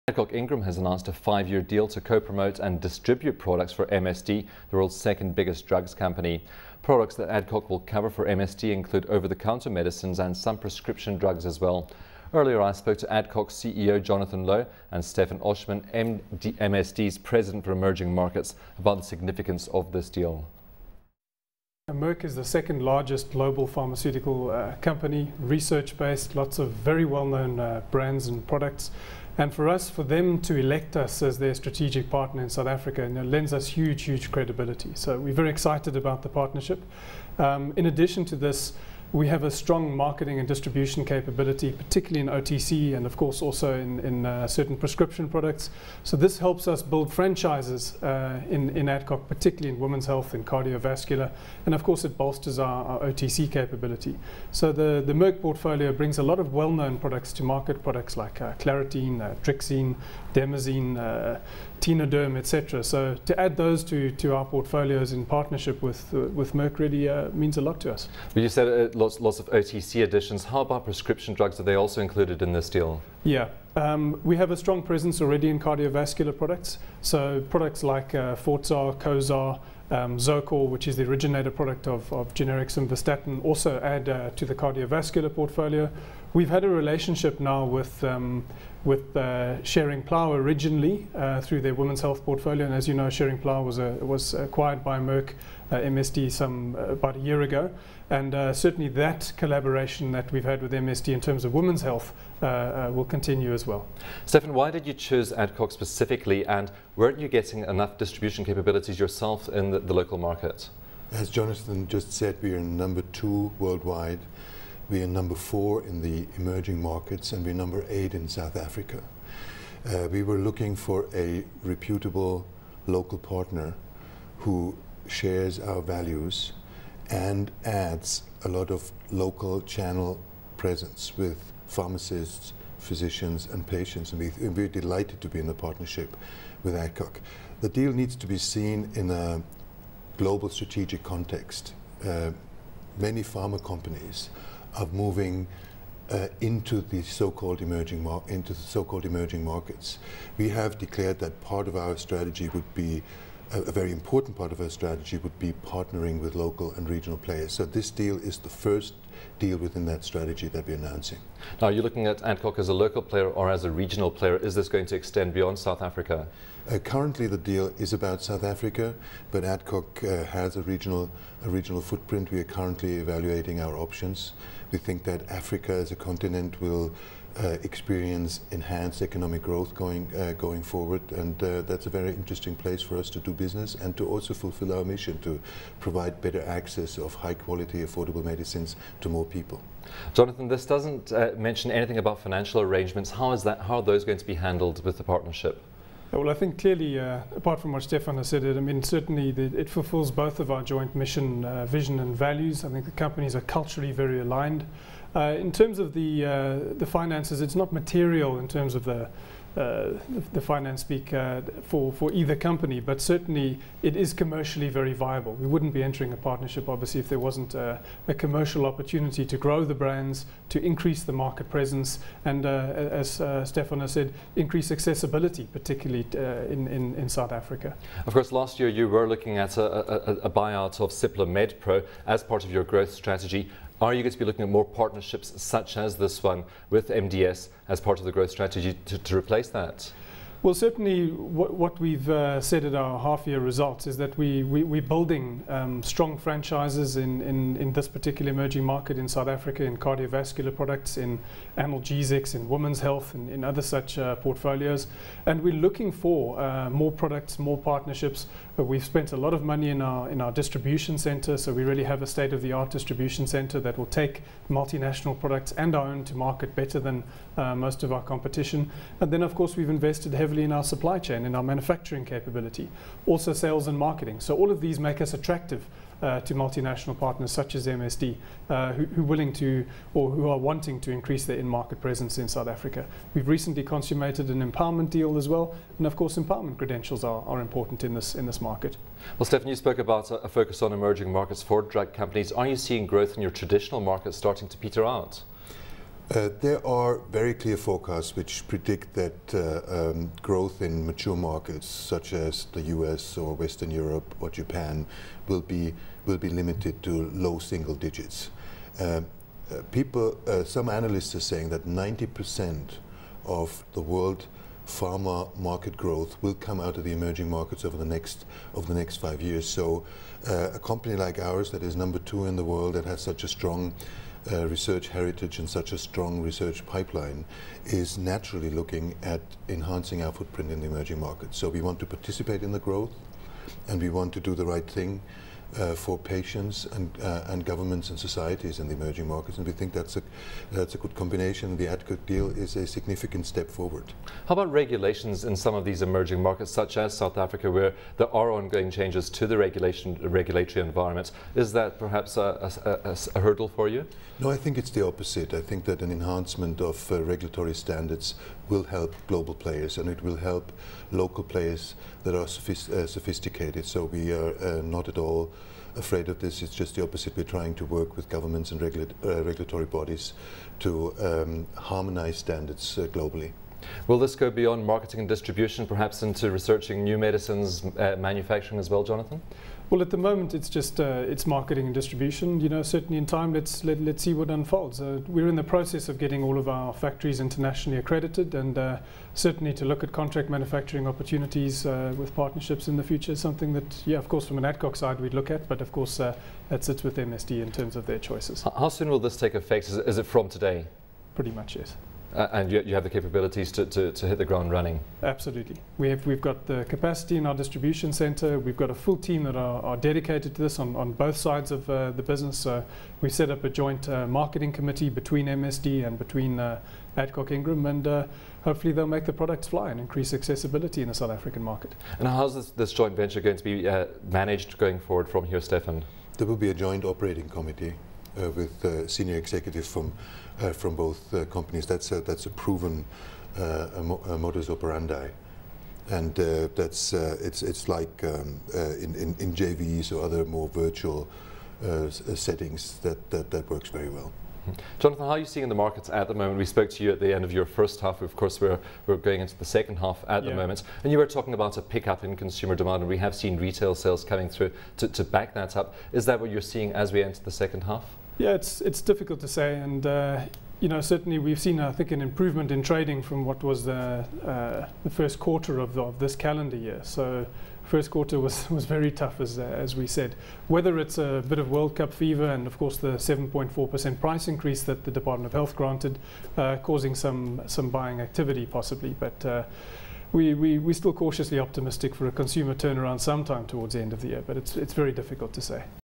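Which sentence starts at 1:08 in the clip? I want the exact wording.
But you said uh, lots, lots of OTC additions.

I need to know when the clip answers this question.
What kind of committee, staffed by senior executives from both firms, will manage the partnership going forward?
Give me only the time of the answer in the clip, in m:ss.
7:06.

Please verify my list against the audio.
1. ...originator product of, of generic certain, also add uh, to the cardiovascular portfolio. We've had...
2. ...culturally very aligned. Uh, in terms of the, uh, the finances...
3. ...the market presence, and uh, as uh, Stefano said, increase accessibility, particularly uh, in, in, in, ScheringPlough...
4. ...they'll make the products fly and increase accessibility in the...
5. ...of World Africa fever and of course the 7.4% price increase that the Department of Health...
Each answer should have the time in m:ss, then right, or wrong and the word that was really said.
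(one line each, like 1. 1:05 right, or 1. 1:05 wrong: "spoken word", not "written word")
1. 1:21 wrong: "simvastatin", not "certain"
2. 3:23 right
3. 3:41 wrong: "South", not "ScheringPlough"
4. 6:58 right
5. 7:51 wrong: "Cup", not "Africa".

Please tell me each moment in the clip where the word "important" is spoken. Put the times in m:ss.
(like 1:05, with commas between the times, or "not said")
2:33, 4:47.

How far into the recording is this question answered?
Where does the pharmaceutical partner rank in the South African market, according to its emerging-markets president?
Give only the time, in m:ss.
1:57.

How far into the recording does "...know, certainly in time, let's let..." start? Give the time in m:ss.
6:22.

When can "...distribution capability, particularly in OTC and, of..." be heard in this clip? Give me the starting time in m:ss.
0:40.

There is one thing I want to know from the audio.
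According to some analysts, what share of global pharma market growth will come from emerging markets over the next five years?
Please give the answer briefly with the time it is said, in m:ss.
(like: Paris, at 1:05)
90%, at 5:11.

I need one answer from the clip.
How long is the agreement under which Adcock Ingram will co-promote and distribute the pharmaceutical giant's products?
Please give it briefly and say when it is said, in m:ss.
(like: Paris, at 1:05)
5 years, at 0:01.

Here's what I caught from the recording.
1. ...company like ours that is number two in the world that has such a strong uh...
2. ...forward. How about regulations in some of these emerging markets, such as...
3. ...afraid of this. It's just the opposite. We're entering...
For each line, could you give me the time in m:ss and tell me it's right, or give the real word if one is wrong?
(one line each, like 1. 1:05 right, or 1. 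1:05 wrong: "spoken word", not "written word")
1. 5:20 right
2. 5:43 right
3. 6:05 wrong: "trying", not "entering".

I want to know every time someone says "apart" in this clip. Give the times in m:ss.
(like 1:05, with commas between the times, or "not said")
3:17.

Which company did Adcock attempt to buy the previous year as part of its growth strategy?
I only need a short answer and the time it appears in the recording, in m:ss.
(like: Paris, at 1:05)
Cipla MedPro, at 3:50.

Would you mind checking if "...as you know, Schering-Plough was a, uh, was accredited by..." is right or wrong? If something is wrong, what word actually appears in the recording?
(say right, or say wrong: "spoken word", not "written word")
wrong: "acquired", not "accredited".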